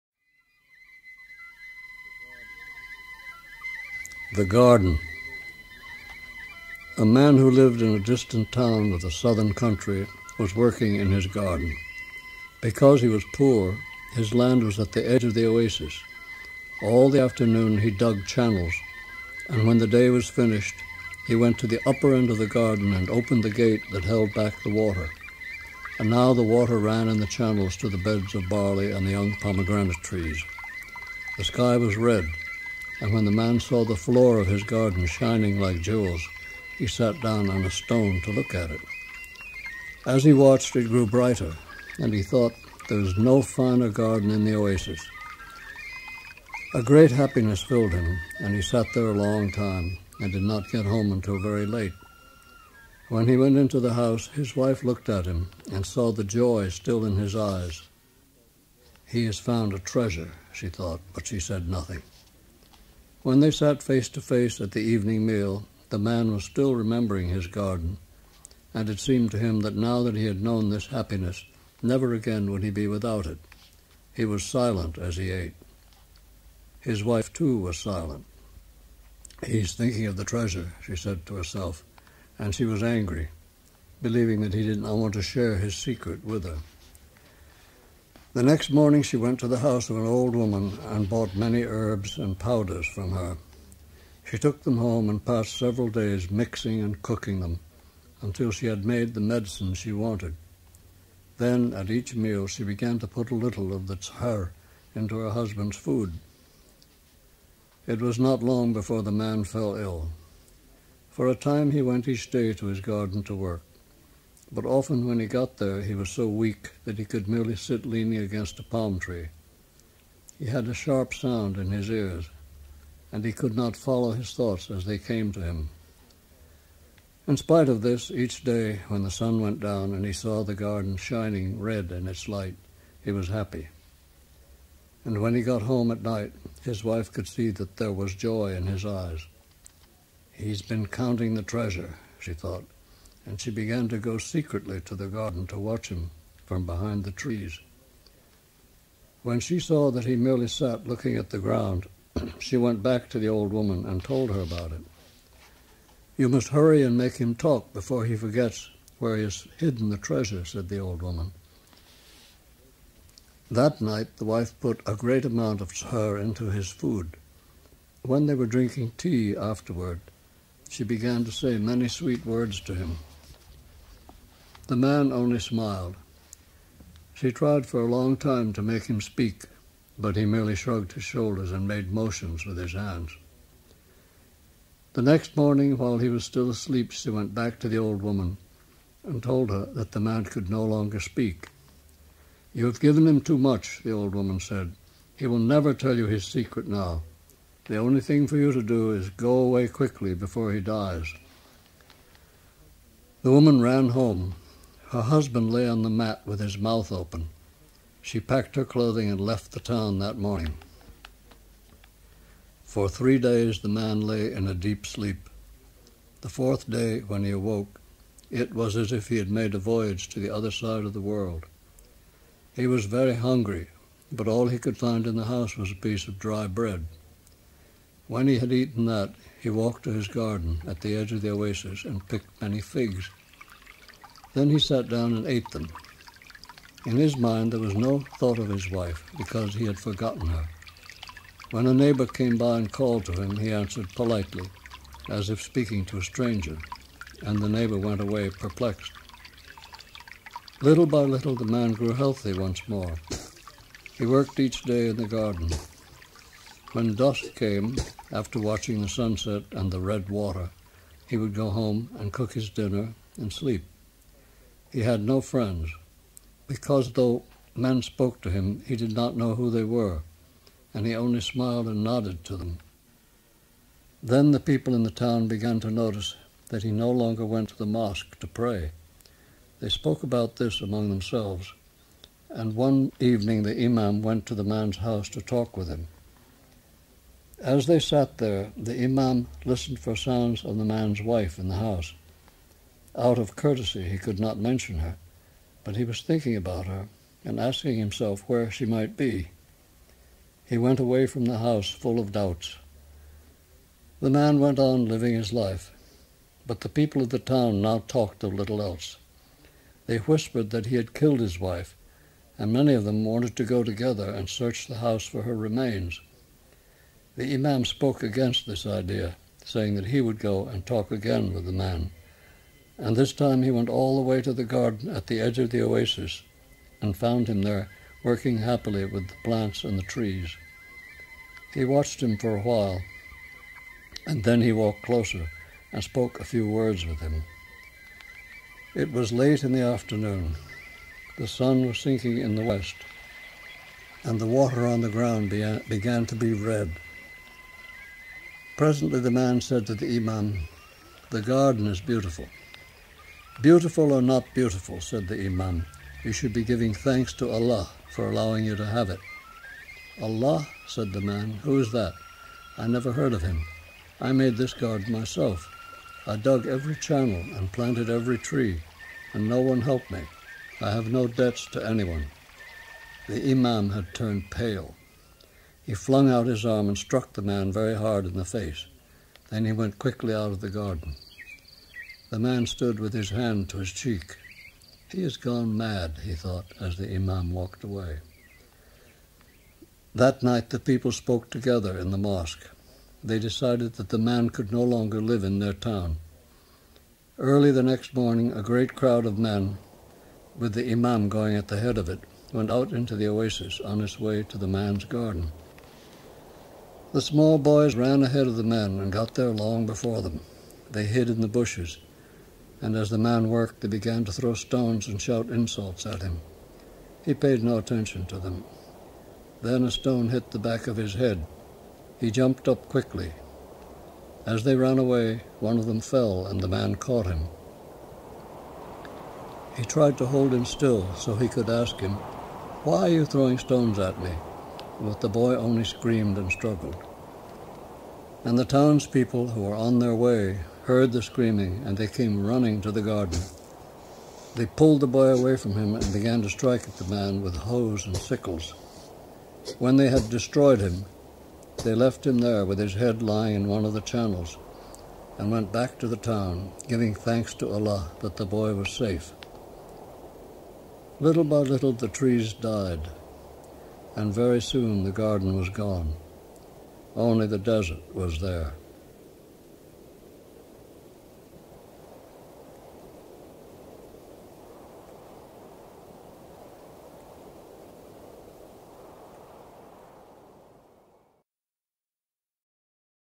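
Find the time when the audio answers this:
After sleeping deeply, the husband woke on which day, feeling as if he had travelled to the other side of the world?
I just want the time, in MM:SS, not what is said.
03:36.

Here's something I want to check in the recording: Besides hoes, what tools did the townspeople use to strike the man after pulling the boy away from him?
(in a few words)
sickles.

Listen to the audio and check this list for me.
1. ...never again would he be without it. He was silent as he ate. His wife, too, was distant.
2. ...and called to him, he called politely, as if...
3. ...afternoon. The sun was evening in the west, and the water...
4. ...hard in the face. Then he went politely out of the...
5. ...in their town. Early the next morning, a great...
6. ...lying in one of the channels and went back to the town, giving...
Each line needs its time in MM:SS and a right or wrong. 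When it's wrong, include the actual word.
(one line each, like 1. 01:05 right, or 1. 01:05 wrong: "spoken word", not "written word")
1. 01:11 wrong: "silent", not "distant"
2. 04:02 wrong: "answered", not "called"
3. 05:39 wrong: "sinking", not "evening"
4. 06:17 wrong: "quickly", not "politely"
5. 06:35 right
6. 07:33 right.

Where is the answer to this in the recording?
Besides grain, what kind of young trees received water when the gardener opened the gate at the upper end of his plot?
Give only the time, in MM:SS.
00:29.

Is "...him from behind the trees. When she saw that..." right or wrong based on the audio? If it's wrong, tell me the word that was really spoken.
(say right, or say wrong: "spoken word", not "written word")
right.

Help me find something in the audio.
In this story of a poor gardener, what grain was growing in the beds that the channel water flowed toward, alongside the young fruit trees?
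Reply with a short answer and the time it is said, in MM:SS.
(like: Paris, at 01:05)
barley, at 00:28.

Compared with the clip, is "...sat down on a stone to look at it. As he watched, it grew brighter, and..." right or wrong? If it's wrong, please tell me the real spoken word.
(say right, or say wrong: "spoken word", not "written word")
right.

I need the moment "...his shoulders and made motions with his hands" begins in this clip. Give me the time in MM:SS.
03:00.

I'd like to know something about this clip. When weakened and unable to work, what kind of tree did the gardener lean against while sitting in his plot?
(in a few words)
palm tree.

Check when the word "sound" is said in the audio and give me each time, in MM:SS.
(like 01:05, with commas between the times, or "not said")
02:01, 04:49.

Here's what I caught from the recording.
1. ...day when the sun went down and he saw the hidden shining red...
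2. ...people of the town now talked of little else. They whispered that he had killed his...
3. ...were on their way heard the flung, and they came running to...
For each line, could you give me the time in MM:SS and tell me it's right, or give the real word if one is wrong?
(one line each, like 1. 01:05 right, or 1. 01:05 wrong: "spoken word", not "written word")
1. 02:08 wrong: "garden", not "hidden"
2. 05:06 right
3. 07:19 wrong: "screaming", not "flung".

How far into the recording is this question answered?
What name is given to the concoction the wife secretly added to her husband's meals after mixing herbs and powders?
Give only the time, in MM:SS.
01:43.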